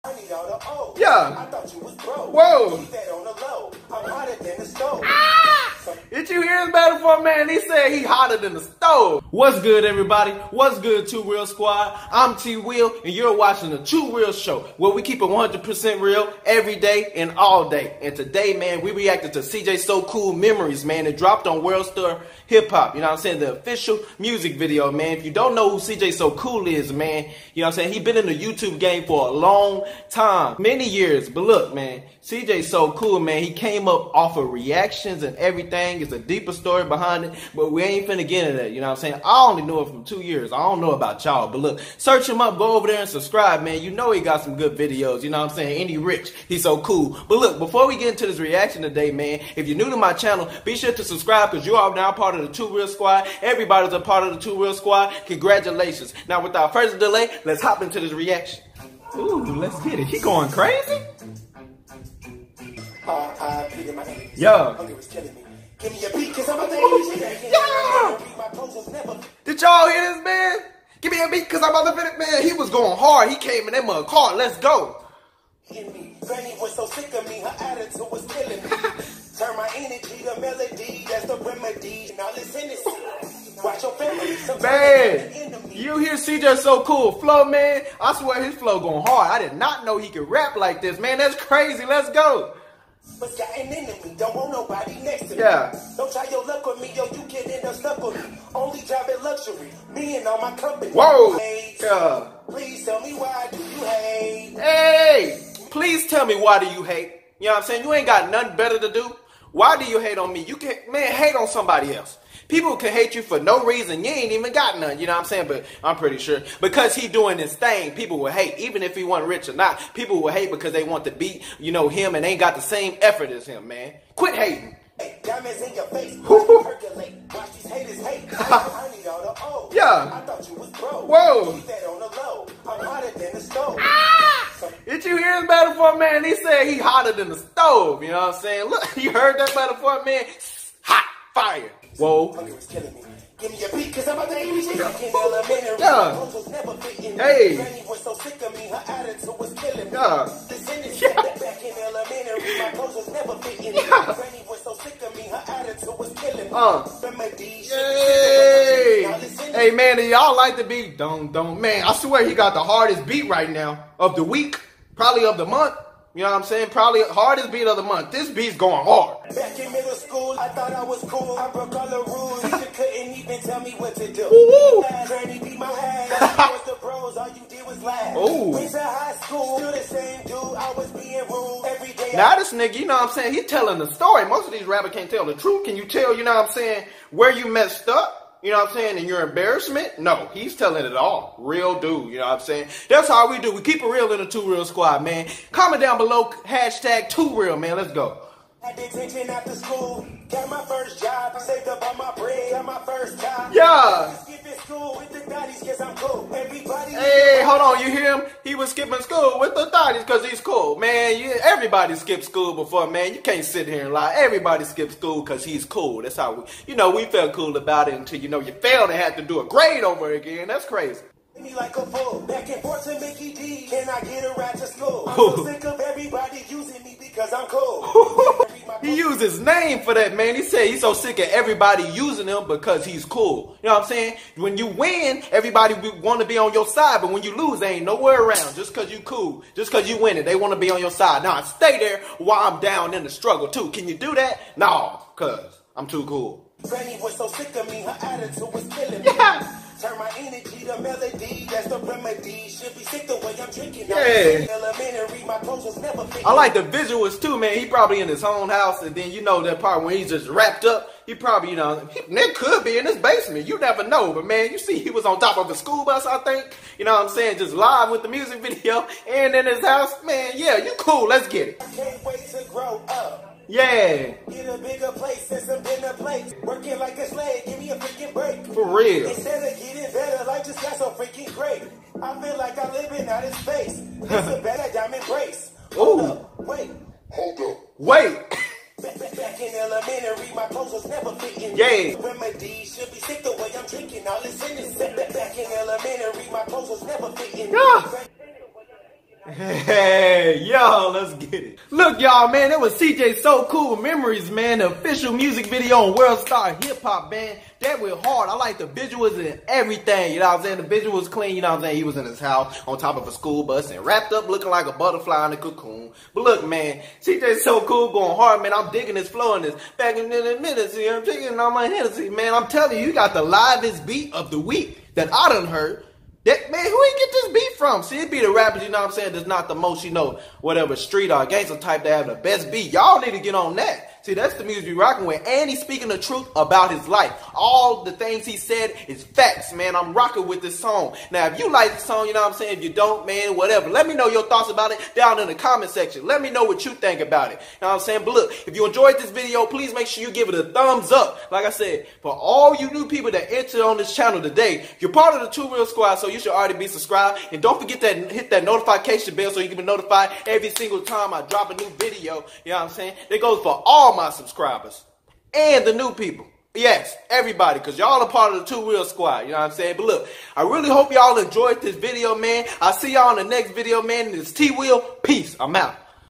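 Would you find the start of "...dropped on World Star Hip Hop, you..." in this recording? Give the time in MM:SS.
00:21.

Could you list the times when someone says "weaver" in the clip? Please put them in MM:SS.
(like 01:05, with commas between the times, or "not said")
not said.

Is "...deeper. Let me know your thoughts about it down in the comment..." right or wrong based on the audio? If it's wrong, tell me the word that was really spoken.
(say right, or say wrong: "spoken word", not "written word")
wrong: "whatever", not "deeper".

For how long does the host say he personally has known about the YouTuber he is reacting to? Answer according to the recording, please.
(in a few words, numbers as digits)
2 years.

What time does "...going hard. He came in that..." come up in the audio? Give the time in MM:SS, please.
01:12.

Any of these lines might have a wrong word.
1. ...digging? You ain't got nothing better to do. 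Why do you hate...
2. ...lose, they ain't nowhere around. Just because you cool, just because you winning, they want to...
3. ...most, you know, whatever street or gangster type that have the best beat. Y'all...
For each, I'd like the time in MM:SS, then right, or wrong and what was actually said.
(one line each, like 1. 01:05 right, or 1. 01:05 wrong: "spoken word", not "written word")
1. 01:47 wrong: "saying", not "digging"
2. 03:57 right
3. 05:29 right.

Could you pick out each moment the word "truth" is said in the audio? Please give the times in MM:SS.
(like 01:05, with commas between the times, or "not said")
03:05, 05:35.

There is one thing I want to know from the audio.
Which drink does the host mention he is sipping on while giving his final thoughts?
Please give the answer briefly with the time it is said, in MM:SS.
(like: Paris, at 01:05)
Hennessy, at 05:21.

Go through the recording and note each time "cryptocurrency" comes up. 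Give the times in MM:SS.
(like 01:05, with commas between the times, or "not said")
not said.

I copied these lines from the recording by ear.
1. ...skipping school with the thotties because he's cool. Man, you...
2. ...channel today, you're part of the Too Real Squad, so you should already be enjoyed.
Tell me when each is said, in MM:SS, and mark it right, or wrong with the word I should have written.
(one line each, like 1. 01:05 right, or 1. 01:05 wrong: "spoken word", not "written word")
1. 03:28 right
2. 05:53 wrong: "subscribed", not "enjoyed".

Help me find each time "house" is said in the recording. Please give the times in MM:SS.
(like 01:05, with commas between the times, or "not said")
04:18, 04:29, 05:12.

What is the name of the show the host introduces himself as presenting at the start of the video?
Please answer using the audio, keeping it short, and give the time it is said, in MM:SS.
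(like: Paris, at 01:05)
Too Real Show, at 00:13.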